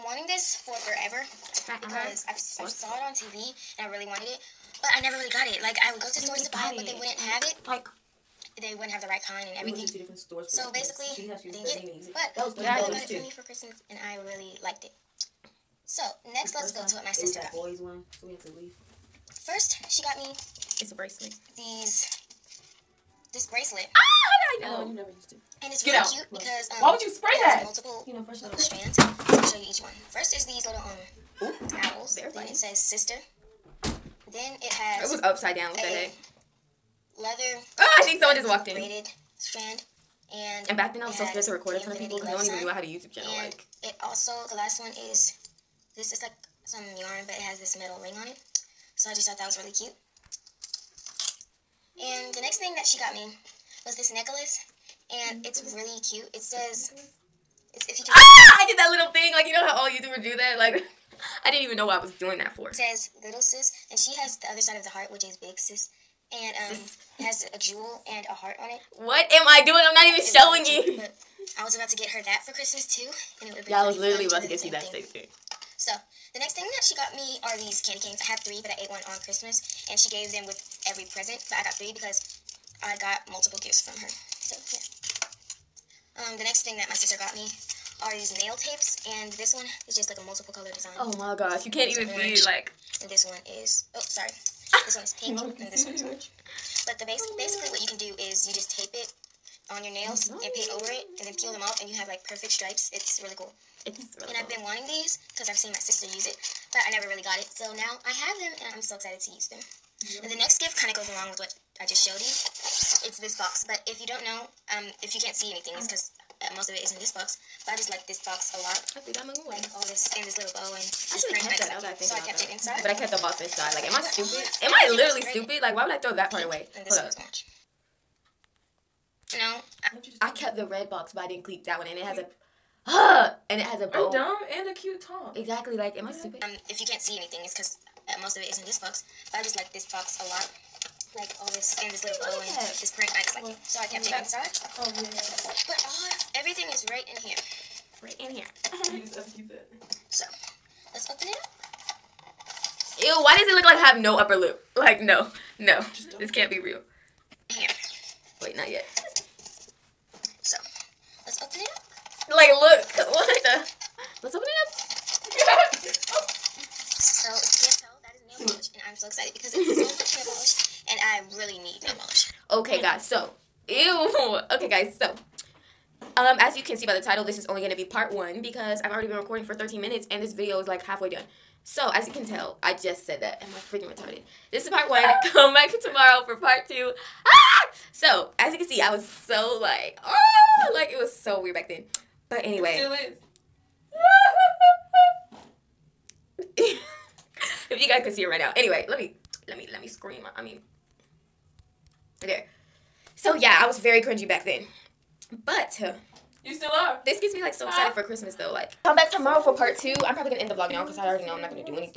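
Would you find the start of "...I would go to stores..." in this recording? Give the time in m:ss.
0:05.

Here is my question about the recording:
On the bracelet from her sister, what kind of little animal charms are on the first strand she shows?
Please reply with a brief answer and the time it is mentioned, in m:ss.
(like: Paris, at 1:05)
Owls, at 0:31.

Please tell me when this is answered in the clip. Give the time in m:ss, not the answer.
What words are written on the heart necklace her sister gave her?
1:03.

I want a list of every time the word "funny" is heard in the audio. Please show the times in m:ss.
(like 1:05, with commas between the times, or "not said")
0:32.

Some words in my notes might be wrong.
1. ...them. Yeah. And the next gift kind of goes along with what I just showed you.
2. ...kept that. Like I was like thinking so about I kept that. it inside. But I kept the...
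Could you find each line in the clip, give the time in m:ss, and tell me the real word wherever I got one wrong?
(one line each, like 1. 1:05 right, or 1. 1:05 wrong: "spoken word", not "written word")
1. 1:49 right
2. 2:01 right.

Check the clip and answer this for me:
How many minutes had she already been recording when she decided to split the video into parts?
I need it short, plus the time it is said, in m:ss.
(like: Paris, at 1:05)
13, at 2:59.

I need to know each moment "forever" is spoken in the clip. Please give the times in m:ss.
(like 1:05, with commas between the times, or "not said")
0:00.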